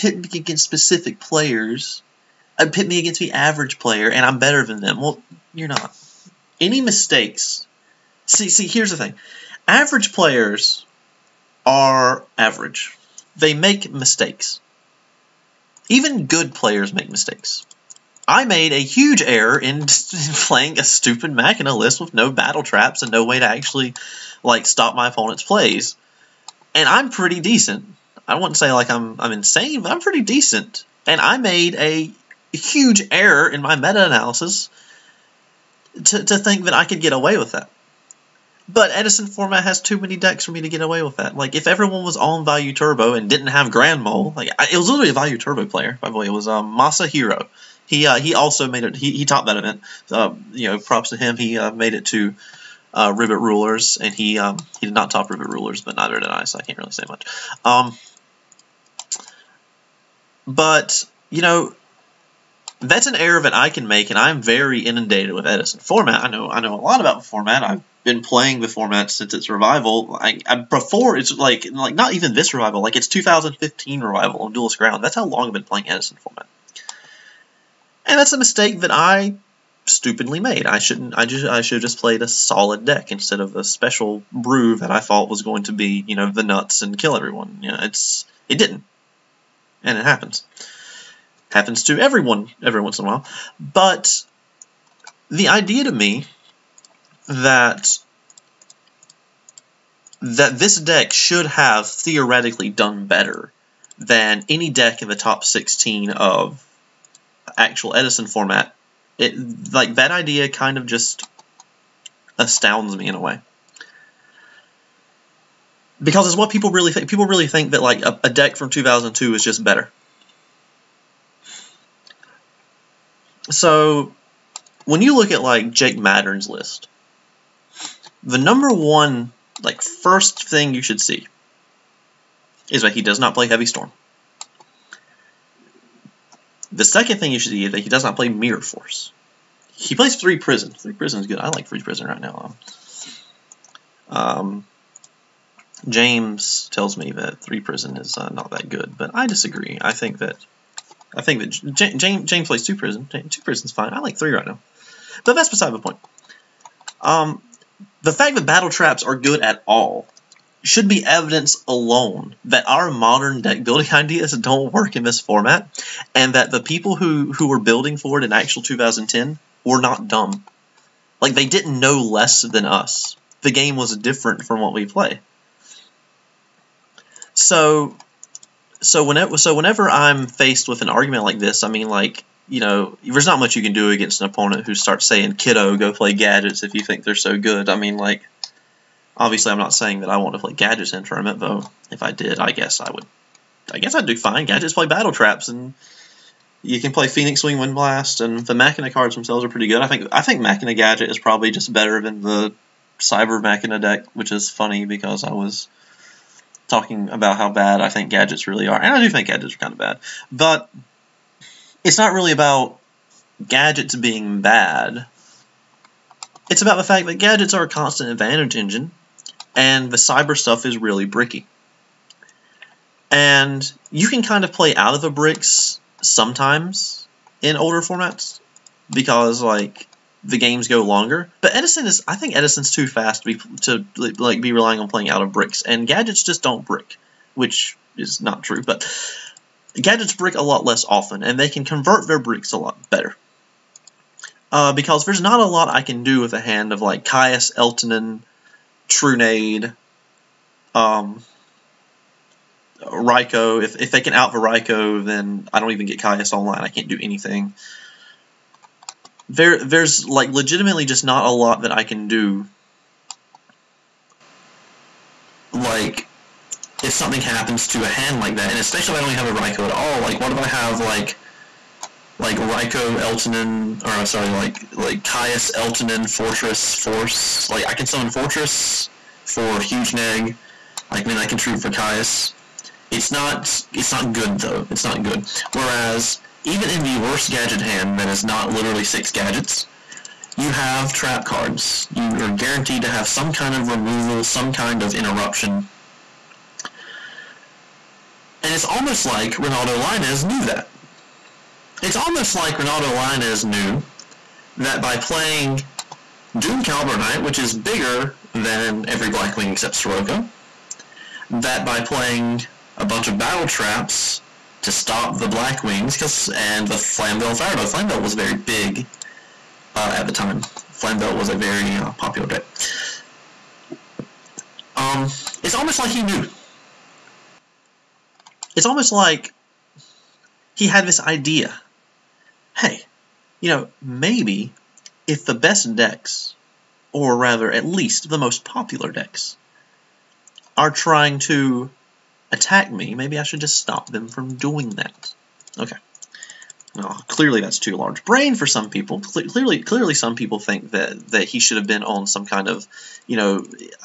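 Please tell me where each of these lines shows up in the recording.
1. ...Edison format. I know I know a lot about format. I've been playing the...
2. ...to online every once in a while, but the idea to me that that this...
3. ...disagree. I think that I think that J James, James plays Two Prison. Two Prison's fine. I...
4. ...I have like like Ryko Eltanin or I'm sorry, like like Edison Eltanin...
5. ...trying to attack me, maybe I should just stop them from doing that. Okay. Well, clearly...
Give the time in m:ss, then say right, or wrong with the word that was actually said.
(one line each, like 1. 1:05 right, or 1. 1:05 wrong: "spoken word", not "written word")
1. 1:05 right
2. 1:31 wrong: "everyone", not "online"
3. 2:29 right
4. 4:30 wrong: "Caius", not "Edison"
5. 5:40 right.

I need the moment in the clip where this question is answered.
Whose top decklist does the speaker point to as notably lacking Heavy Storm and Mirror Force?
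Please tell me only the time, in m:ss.
2:05.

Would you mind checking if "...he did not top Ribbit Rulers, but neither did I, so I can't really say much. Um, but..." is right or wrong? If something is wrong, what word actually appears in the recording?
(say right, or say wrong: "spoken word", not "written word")
right.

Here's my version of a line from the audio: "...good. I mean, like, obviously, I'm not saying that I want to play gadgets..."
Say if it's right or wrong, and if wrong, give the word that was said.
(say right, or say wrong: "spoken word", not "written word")
right.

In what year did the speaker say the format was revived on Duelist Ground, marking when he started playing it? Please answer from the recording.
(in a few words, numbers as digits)
2015.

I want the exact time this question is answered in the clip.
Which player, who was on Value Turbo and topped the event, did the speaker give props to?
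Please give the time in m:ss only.
0:47.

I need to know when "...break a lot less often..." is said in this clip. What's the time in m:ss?
4:00.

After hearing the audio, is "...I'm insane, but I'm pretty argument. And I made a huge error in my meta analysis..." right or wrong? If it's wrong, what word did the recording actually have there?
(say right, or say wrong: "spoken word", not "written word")
wrong: "decent", not "argument".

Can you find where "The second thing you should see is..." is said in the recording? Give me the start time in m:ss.
2:16.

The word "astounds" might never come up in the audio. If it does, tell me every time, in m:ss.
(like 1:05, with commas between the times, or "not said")
1:52.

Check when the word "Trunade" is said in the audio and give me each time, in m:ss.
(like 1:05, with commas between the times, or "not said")
4:08.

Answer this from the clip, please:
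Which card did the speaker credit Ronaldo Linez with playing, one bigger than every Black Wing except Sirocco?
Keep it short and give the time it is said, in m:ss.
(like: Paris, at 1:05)
Doom Caliber Knight, at 5:06.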